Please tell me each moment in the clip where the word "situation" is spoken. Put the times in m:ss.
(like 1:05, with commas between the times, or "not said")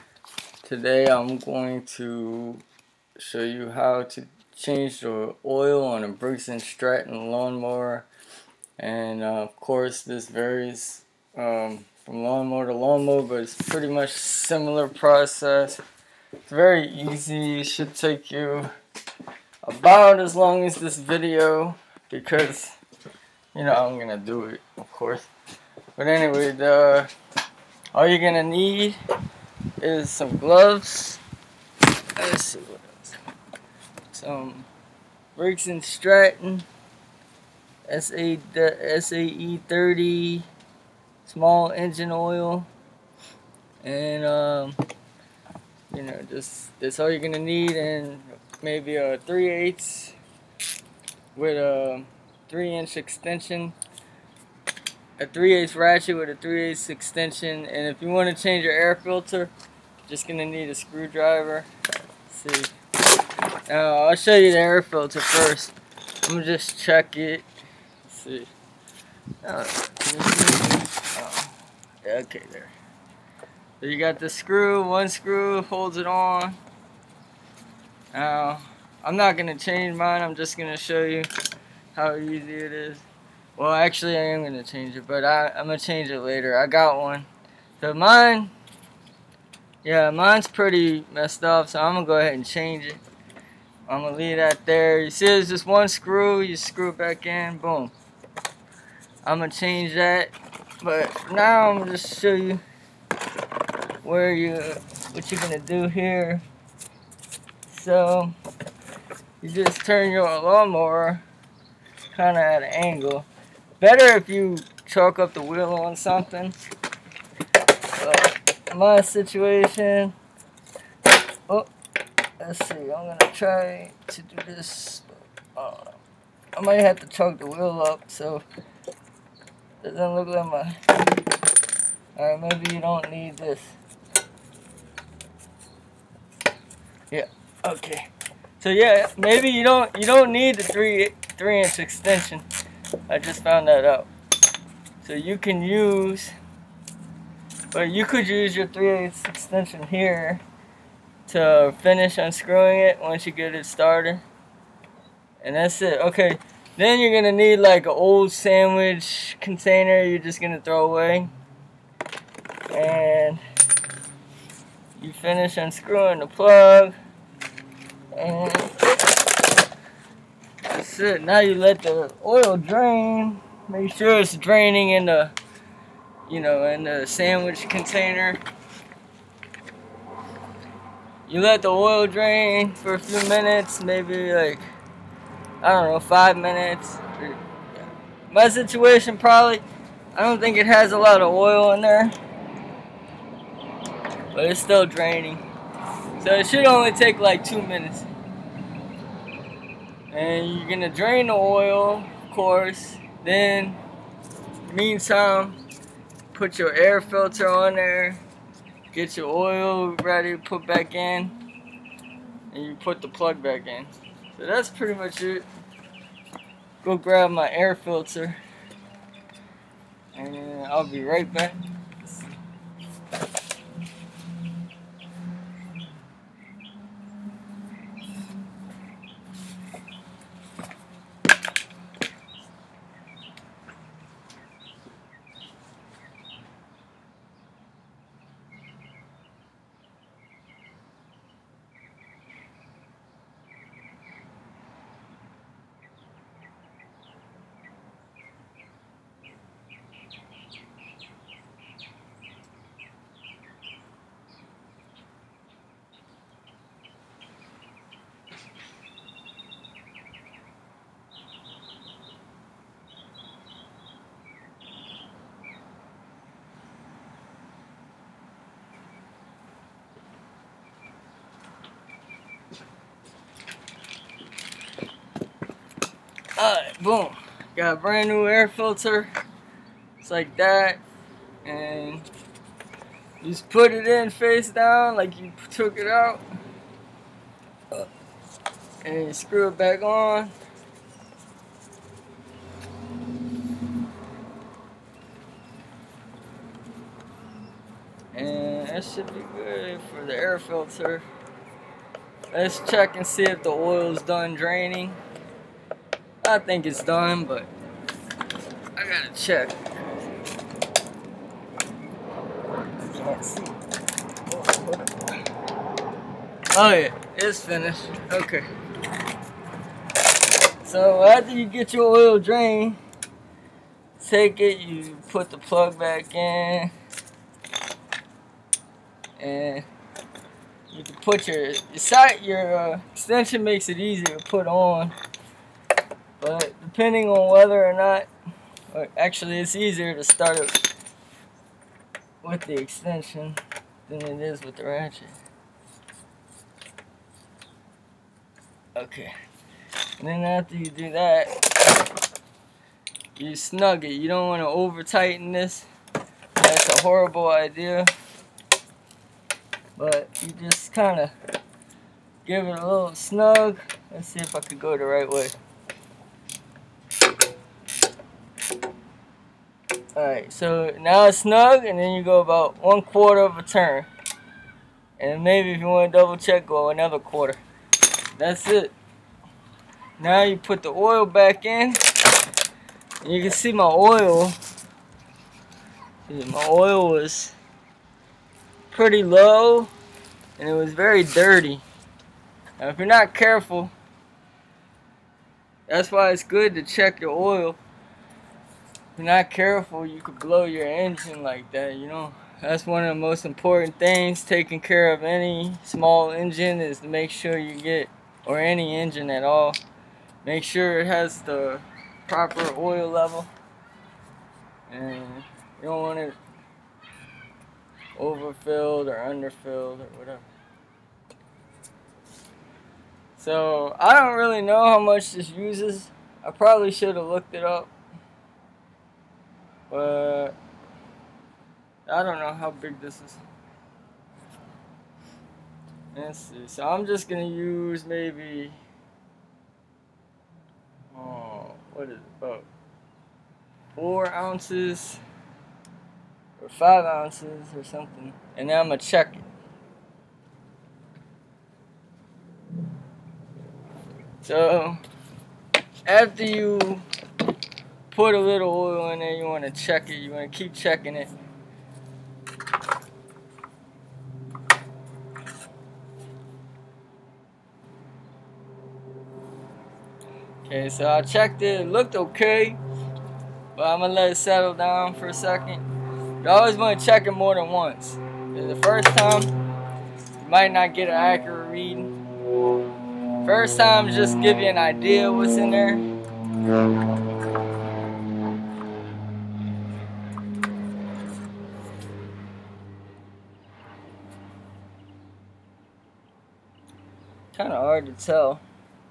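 1:59, 3:08.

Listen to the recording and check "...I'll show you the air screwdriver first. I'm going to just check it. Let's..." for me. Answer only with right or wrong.
wrong.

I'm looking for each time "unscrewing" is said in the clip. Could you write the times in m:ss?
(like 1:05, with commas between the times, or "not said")
2:32, 2:45.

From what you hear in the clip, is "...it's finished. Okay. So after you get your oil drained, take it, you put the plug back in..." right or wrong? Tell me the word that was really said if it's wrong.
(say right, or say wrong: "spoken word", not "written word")
right.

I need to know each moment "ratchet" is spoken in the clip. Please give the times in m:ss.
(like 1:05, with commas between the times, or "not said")
0:55, 5:44.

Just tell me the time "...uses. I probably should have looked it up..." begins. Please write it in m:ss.
7:05.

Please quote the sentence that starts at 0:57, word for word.
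And if you want to change your air filter, just going to need a screwdriver.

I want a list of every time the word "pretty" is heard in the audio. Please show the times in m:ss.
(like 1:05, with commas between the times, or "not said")
0:13, 1:30, 3:34, 6:28.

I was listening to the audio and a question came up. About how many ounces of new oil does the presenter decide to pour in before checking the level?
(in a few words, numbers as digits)
4 or 5 ounces.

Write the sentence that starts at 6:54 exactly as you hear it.
And you don't want it overfilled or underfilled or whatever.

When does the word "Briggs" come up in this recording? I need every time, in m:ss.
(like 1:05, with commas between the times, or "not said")
0:06, 0:35.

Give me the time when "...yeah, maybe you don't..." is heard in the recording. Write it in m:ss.
2:18.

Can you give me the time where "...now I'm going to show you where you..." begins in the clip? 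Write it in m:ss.
1:41.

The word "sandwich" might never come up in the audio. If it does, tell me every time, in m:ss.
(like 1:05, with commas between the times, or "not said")
2:38, 2:57.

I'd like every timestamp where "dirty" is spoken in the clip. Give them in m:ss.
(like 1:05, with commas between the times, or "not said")
6:31.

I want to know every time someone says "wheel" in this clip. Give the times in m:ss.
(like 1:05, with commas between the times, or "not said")
1:55, 2:07.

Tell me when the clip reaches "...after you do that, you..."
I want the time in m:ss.
5:50.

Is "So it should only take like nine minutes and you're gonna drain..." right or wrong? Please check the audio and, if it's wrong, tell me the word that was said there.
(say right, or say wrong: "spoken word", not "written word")
wrong: "two", not "nine".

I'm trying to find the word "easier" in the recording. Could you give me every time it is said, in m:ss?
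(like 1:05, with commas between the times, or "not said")
5:33, 5:39.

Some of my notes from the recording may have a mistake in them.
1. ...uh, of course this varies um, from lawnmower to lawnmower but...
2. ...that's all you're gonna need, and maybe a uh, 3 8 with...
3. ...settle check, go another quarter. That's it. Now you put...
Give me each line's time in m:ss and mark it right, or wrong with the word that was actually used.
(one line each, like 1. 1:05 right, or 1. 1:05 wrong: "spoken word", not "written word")
1. 0:09 right
2. 0:46 right
3. 6:15 wrong: "double", not "settle".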